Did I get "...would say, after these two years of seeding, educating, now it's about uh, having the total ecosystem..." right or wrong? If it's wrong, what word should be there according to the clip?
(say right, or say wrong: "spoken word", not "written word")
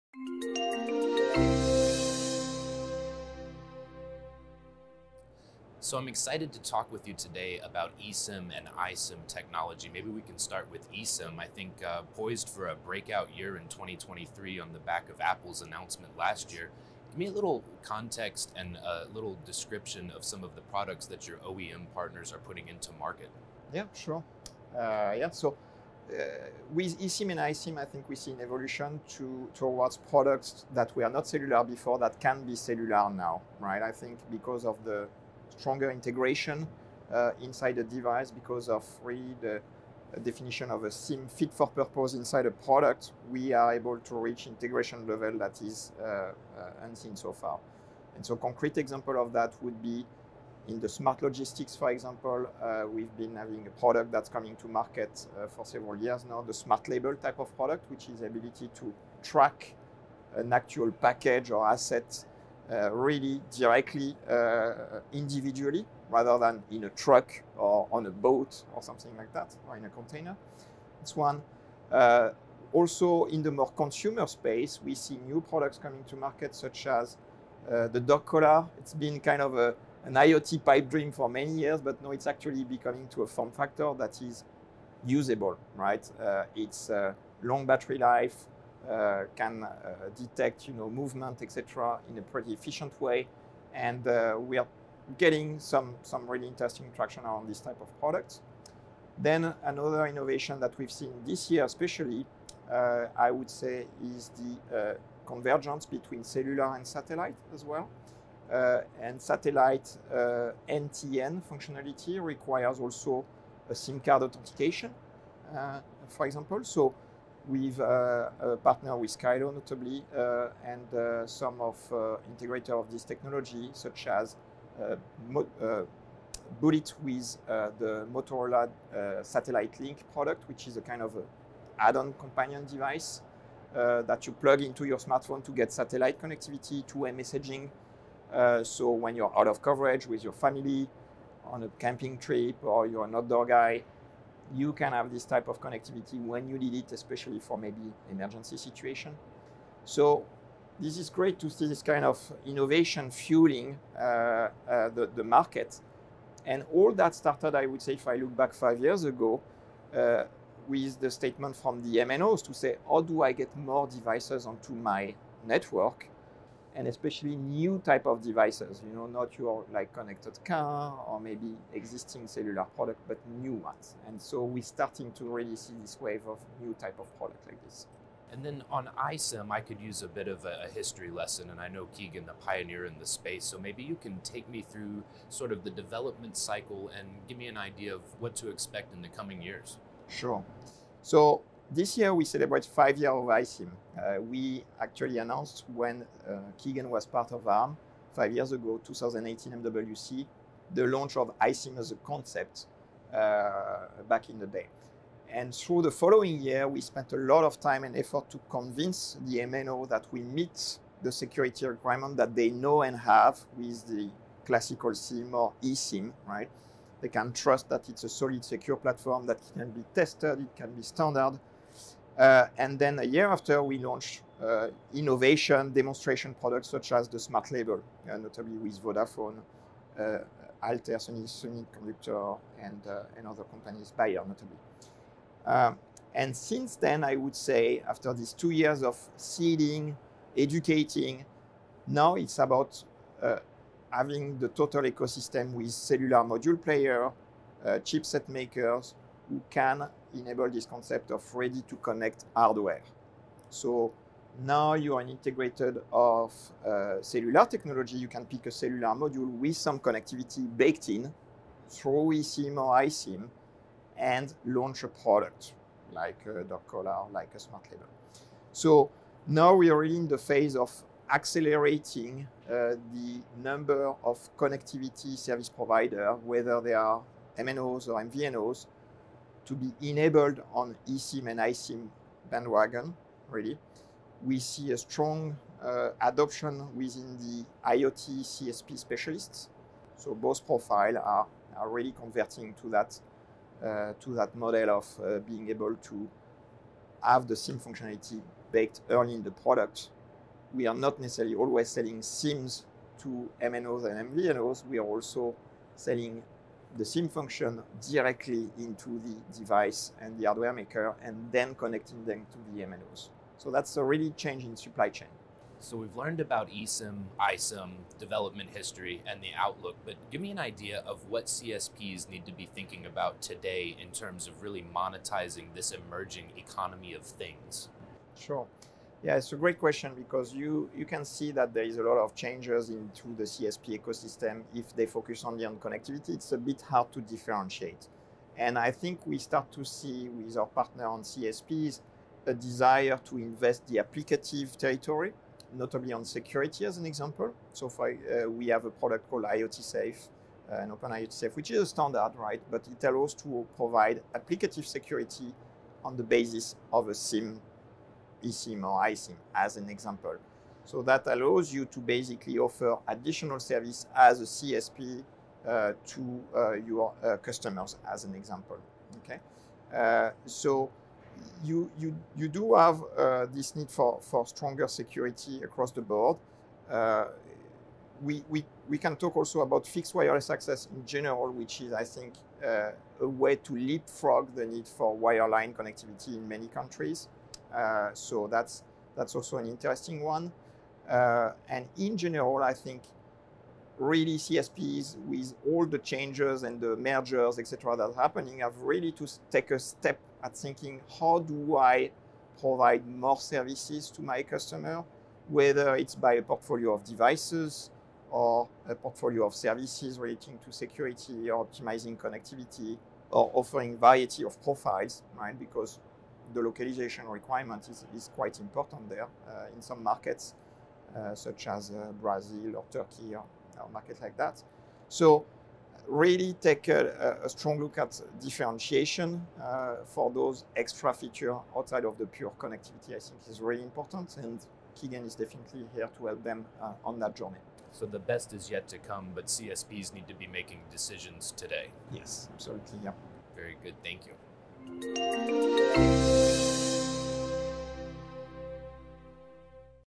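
right.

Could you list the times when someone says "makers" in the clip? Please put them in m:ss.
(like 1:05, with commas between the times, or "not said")
4:08, 5:10.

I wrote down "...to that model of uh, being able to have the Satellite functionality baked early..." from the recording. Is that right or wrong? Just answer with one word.
wrong.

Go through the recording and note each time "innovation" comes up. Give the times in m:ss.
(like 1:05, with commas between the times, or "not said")
1:40, 2:32, 3:44.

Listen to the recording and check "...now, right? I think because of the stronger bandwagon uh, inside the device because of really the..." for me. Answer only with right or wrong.
wrong.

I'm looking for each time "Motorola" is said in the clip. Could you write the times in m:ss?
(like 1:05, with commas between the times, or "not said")
2:08.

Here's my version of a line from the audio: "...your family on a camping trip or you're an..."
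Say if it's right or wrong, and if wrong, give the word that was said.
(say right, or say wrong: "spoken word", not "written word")
right.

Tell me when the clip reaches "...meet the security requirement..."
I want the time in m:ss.
3:30.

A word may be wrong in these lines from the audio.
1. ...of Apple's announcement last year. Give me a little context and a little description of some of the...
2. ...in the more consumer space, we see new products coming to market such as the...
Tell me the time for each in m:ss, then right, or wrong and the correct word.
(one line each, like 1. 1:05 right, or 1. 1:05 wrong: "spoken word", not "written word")
1. 0:15 right
2. 1:13 right.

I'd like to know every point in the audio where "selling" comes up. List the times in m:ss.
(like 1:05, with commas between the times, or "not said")
5:01, 5:05.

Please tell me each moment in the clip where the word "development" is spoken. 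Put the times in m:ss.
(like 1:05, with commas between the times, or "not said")
3:05, 5:17.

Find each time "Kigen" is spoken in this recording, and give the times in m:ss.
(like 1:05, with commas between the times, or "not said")
3:01, 3:16, 7:14.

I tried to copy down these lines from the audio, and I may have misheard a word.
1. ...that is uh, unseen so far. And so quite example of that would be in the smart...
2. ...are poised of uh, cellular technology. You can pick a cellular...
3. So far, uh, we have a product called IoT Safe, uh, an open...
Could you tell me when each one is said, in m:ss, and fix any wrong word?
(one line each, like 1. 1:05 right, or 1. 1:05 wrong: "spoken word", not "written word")
1. 0:45 wrong: "concrete", not "quite"
2. 4:14 wrong: "integrated", not "poised"
3. 5:47 right.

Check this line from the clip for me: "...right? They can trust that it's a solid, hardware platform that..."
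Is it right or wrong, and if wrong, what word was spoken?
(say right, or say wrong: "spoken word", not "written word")
wrong: "secure", not "hardware".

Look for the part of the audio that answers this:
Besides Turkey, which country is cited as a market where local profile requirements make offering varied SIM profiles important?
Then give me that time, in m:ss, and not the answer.
7:02.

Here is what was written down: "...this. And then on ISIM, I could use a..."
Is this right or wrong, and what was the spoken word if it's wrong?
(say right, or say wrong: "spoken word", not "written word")
right.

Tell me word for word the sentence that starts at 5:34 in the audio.
If they focus only on connectivity, it's a bit hard to differentiate.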